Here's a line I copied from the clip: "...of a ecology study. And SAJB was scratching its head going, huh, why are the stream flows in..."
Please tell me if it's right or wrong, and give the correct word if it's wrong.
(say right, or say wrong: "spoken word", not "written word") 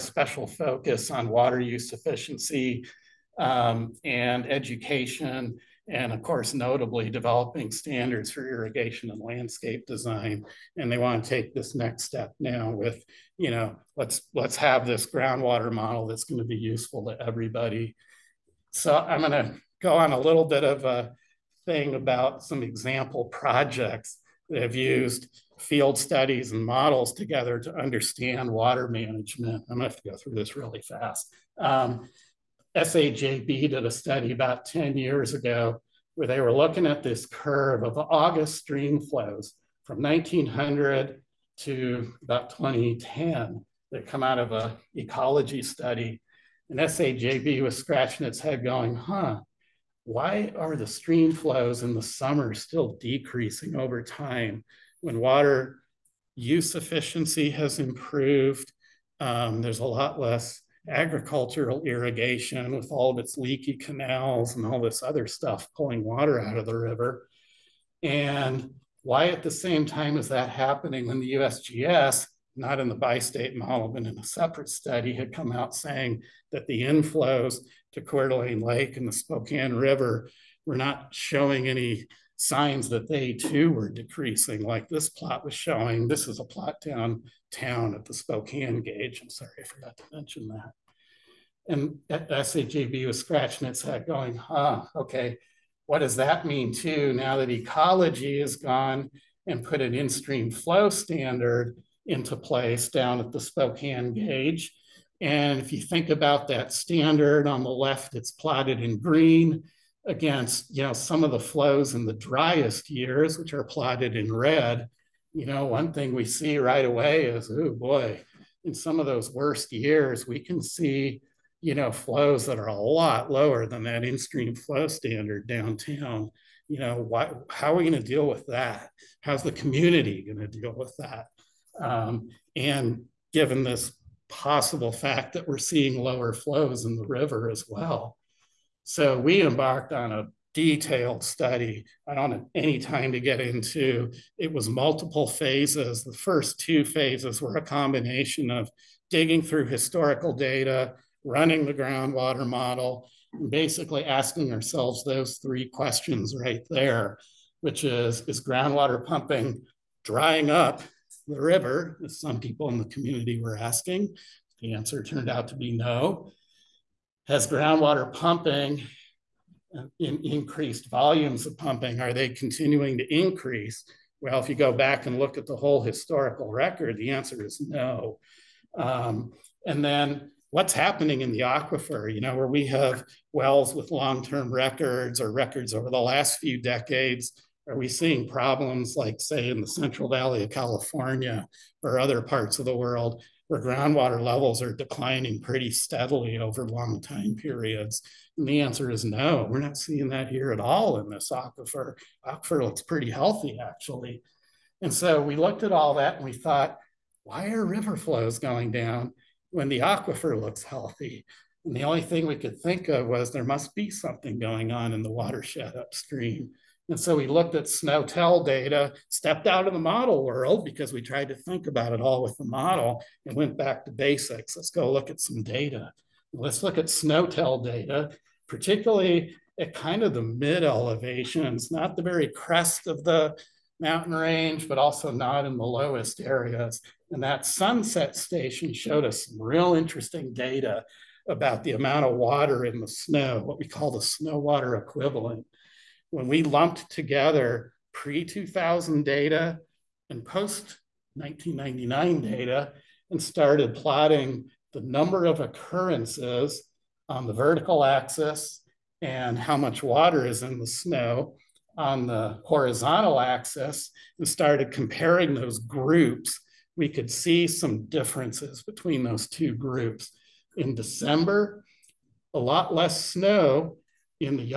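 right.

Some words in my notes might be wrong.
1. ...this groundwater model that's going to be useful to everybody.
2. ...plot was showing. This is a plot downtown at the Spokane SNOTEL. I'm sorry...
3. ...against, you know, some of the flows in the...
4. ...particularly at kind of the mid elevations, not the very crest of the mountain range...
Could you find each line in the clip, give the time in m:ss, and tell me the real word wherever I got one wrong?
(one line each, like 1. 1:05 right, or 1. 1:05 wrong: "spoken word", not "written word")
1. 0:14 right
2. 1:25 wrong: "Gauge", not "SNOTEL"
3. 1:50 right
4. 3:48 right.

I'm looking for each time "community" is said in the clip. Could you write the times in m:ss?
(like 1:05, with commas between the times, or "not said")
2:09, 2:42.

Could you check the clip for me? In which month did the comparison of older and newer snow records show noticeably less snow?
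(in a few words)
December.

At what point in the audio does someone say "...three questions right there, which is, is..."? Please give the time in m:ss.
2:35.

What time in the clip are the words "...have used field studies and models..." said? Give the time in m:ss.
0:24.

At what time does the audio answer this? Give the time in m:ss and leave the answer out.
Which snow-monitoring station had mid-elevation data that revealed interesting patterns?
3:57.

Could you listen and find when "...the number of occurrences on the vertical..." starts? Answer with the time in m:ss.
4:14.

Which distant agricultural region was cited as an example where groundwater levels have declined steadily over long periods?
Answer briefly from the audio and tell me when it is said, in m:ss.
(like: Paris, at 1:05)
Central Valley of California, at 3:09.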